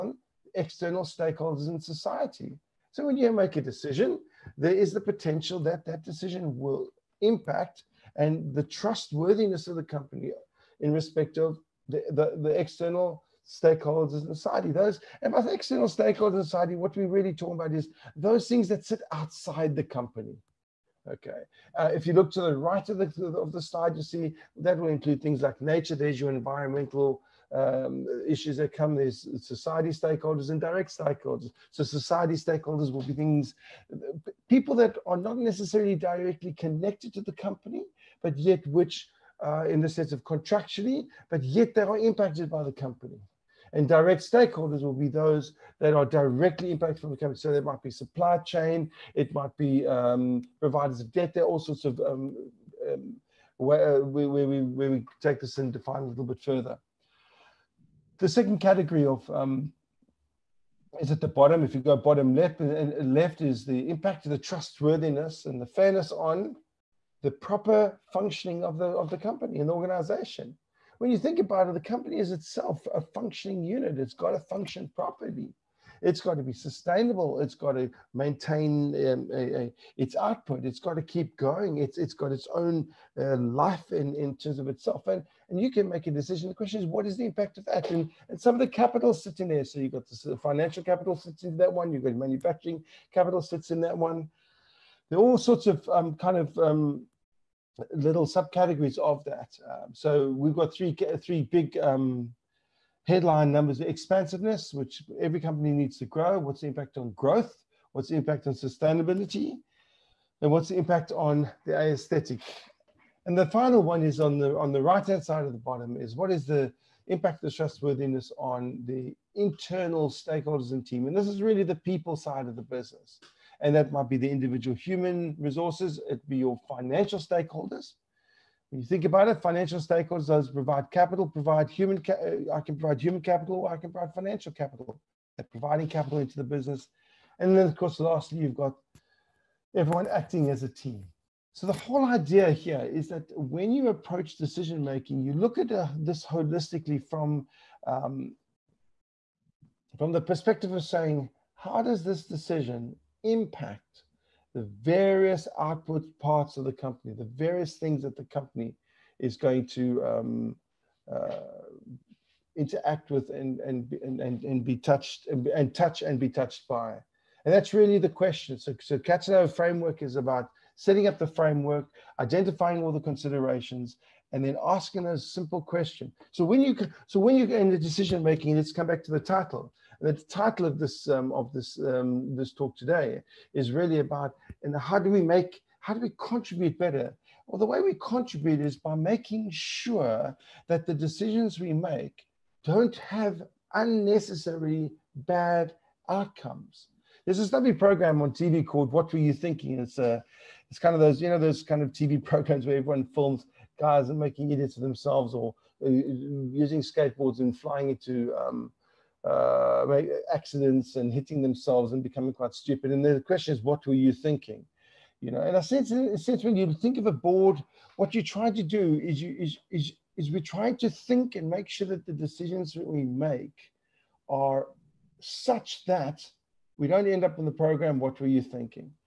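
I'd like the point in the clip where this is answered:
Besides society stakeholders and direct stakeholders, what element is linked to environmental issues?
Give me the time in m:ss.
0:25.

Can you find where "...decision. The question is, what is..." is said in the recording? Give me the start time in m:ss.
1:26.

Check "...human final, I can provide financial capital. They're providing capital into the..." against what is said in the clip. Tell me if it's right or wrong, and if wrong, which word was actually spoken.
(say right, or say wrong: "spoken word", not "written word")
wrong: "capital", not "final".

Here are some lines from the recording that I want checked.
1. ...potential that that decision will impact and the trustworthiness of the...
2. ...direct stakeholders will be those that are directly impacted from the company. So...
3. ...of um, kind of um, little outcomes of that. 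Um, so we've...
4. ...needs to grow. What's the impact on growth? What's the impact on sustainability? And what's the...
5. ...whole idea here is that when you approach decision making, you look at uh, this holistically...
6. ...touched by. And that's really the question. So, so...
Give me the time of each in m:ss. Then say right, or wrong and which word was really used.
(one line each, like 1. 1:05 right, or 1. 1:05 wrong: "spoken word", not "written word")
1. 0:05 right
2. 0:43 right
3. 1:35 wrong: "subcategories", not "outcomes"
4. 1:45 right
5. 2:21 right
6. 2:46 right.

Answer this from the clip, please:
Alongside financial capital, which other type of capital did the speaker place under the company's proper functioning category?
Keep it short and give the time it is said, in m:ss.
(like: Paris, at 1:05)
manufacturing capital, at 1:32.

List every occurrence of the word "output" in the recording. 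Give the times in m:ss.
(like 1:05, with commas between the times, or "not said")
1:20, 2:35.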